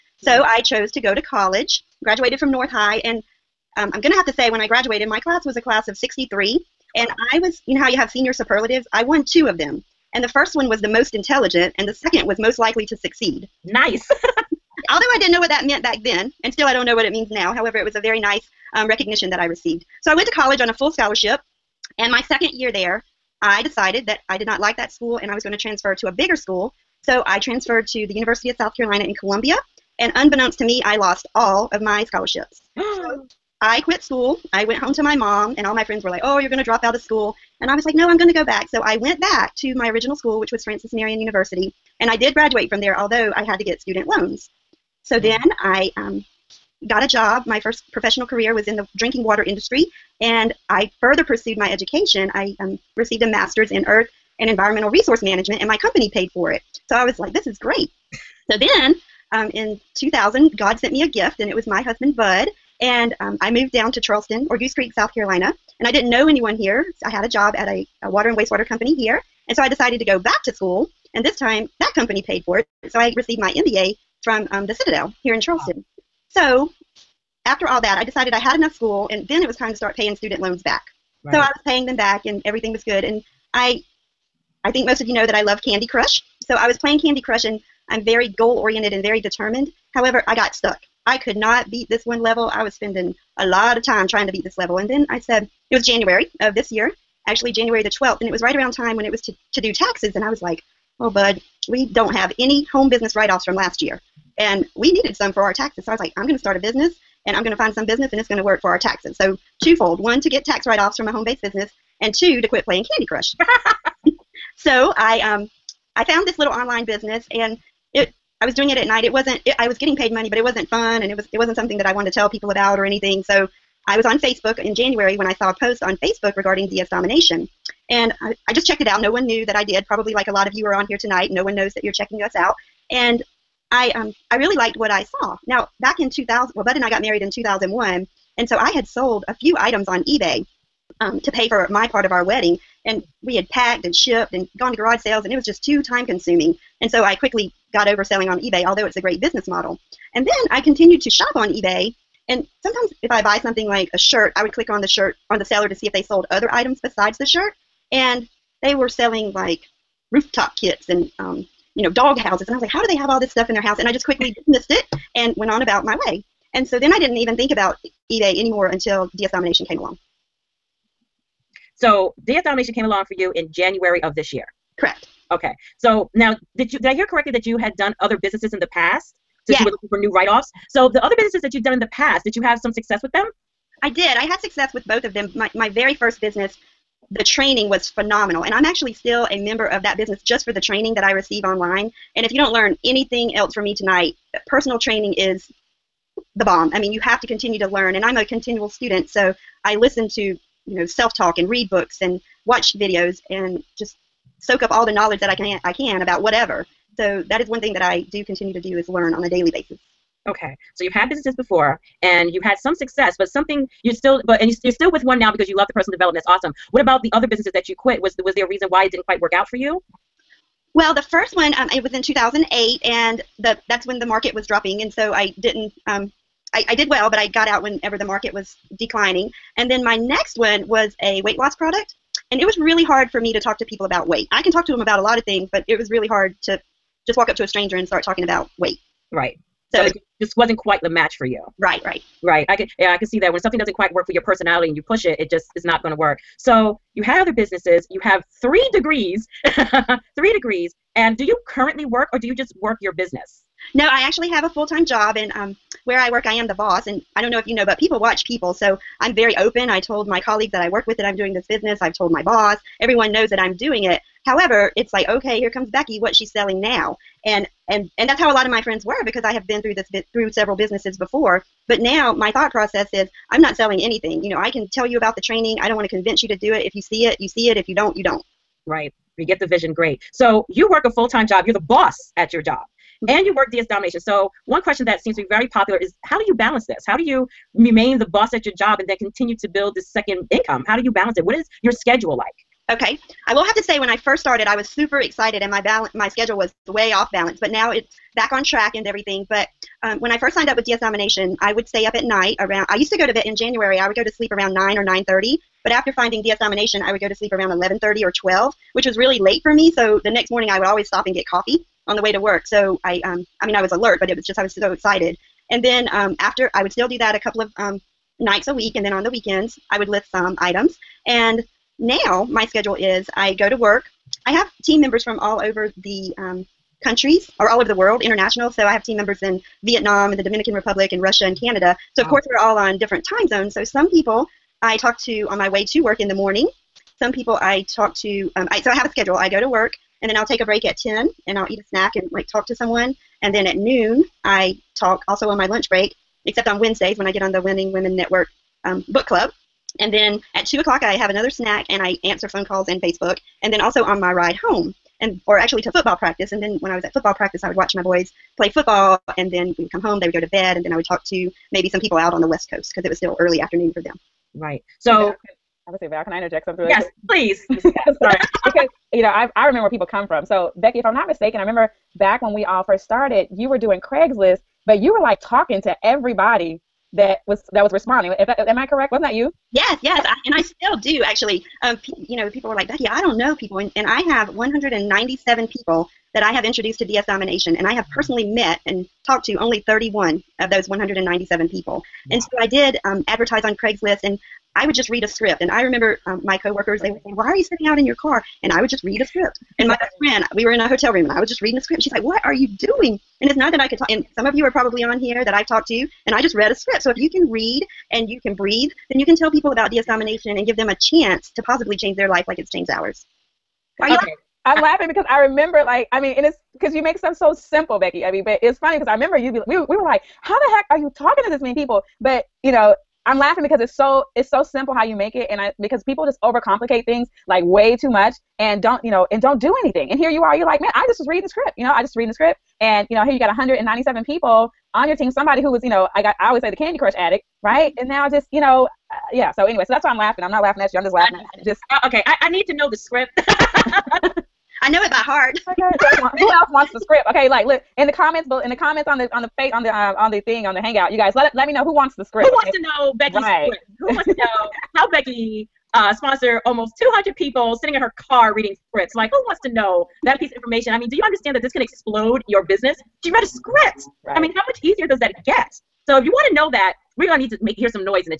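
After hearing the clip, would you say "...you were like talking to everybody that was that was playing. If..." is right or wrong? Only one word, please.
wrong.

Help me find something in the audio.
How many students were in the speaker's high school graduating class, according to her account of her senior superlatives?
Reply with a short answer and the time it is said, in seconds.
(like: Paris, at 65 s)
63, at 5 s.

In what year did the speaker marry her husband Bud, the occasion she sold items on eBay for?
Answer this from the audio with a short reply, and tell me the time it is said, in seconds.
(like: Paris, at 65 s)
2001, at 137 s.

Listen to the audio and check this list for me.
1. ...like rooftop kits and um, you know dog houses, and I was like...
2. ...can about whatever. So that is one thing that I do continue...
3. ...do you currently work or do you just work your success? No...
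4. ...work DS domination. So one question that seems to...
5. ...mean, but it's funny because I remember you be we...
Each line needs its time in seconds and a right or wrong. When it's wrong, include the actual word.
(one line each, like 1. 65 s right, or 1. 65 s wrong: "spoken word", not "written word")
1. 159 s right
2. 205 s right
3. 251 s wrong: "business", not "success"
4. 283 s right
5. 418 s right.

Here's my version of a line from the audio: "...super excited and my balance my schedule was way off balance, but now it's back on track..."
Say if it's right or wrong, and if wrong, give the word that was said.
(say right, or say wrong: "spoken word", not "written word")
right.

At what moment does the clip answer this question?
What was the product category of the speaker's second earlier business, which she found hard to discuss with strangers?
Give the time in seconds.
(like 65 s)
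231 s.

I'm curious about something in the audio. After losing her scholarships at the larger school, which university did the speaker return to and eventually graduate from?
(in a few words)
Francis Marion University.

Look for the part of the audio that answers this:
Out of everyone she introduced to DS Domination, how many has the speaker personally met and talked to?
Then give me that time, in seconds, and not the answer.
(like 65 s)
389 s.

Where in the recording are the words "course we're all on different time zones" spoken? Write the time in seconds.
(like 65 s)
332 s.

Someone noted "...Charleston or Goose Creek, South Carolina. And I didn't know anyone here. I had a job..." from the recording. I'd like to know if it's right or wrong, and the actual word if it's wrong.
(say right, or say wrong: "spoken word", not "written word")
right.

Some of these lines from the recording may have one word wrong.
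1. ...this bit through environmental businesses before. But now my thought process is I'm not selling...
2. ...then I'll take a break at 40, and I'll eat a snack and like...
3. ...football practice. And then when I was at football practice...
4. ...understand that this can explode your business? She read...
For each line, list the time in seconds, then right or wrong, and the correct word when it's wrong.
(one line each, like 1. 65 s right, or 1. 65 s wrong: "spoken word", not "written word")
1. 269 s wrong: "several", not "environmental"
2. 340 s wrong: "10", not "40"
3. 355 s right
4. 461 s right.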